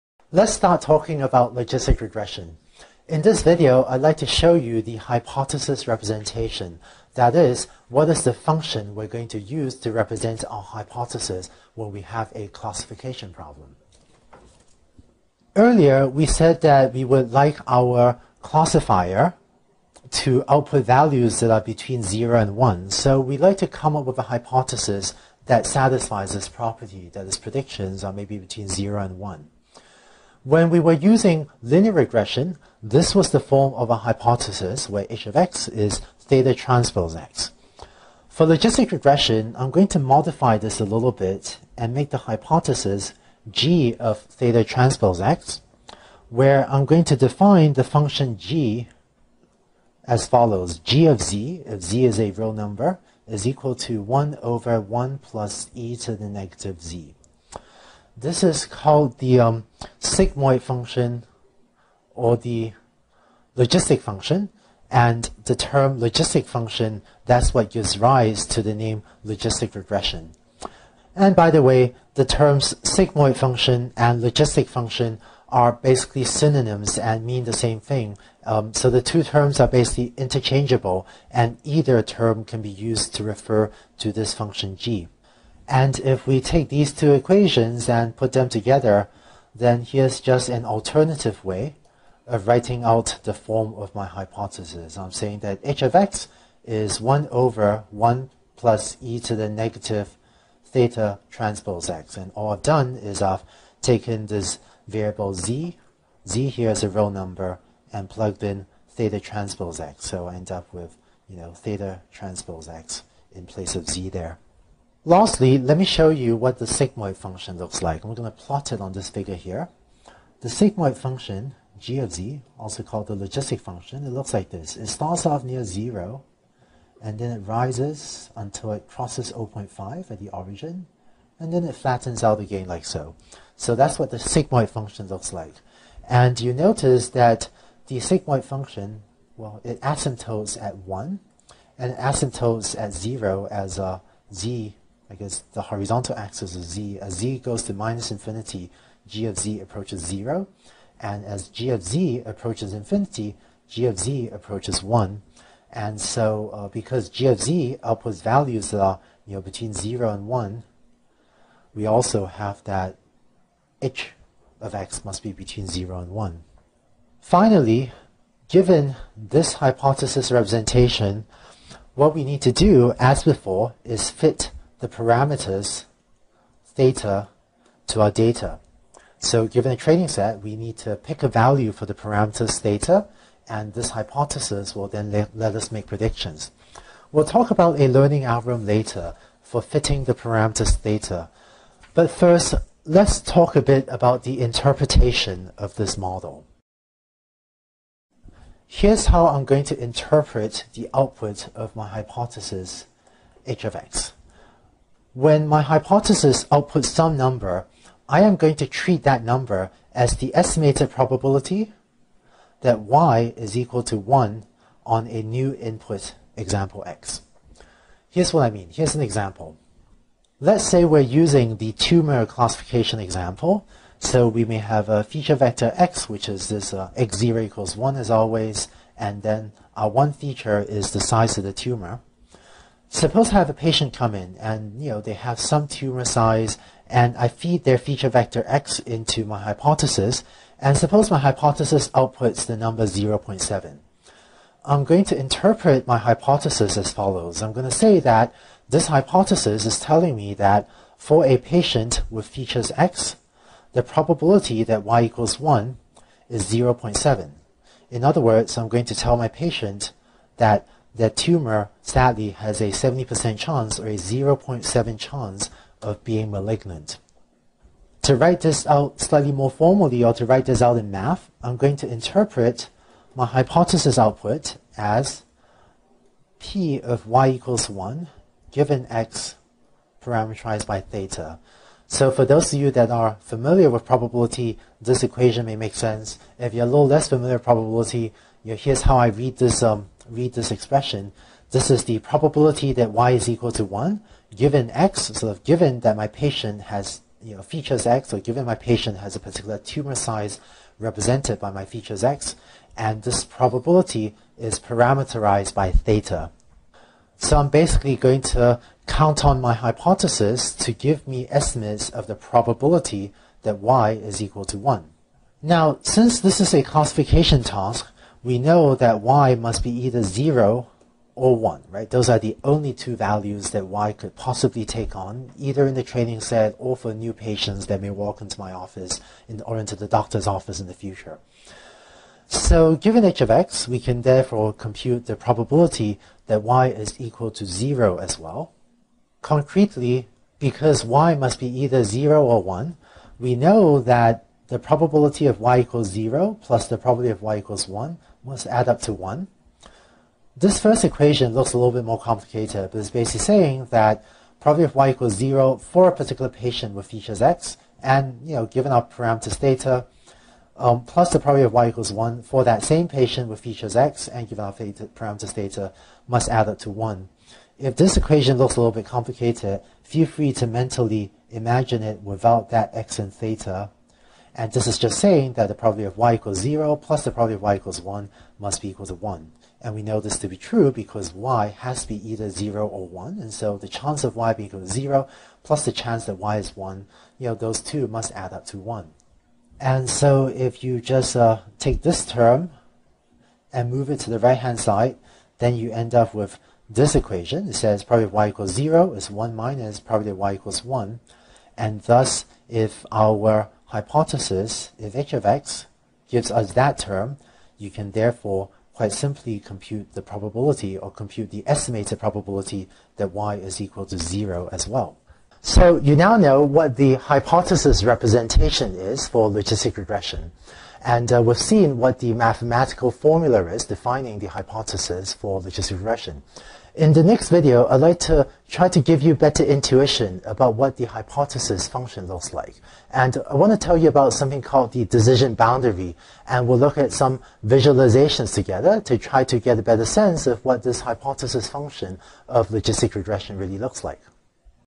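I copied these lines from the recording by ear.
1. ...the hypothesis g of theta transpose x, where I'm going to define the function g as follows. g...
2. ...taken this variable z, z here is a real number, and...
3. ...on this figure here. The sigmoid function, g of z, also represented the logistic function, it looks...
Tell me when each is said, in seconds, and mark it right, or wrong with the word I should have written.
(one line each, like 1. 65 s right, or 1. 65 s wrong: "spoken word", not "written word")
1. 42 s right
2. 103 s right
3. 118 s wrong: "called", not "represented".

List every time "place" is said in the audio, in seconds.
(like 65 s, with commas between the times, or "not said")
113 s.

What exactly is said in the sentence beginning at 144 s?
z because the horizontal axis of z, as z goes to minus infinity, g of z approaches 0.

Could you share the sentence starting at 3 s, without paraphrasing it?
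In this video, I'd like to show you the hypothesis representation.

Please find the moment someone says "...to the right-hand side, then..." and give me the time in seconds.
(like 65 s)
394 s.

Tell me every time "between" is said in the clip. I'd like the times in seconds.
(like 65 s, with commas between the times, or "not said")
21 s, 28 s, 159 s, 165 s.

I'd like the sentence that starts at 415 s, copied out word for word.
So you now know what the hypothesis representation is for logistic regression.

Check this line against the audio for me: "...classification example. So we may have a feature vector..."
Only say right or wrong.
right.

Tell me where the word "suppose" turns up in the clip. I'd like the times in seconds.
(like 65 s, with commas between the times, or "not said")
232 s, 240 s.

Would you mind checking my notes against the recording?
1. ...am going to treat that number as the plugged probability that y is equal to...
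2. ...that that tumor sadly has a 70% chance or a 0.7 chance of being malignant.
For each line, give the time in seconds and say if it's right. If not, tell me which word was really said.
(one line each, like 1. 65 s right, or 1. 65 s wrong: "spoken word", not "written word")
1. 208 s wrong: "estimated", not "plugged"
2. 260 s right.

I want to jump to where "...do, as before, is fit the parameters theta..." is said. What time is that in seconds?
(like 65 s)
172 s.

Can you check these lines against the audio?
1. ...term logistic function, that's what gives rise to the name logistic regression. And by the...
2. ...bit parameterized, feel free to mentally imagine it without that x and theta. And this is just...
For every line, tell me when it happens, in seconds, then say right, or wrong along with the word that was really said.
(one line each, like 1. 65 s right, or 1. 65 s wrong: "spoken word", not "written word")
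1. 65 s right
2. 368 s wrong: "complicated", not "parameterized".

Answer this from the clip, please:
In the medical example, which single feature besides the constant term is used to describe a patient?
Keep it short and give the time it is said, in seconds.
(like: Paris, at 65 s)
size of the tumor, at 230 s.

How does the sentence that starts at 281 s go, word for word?
So for those of you that are familiar with probability, this equation may make sense.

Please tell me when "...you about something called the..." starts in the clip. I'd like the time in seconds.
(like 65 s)
433 s.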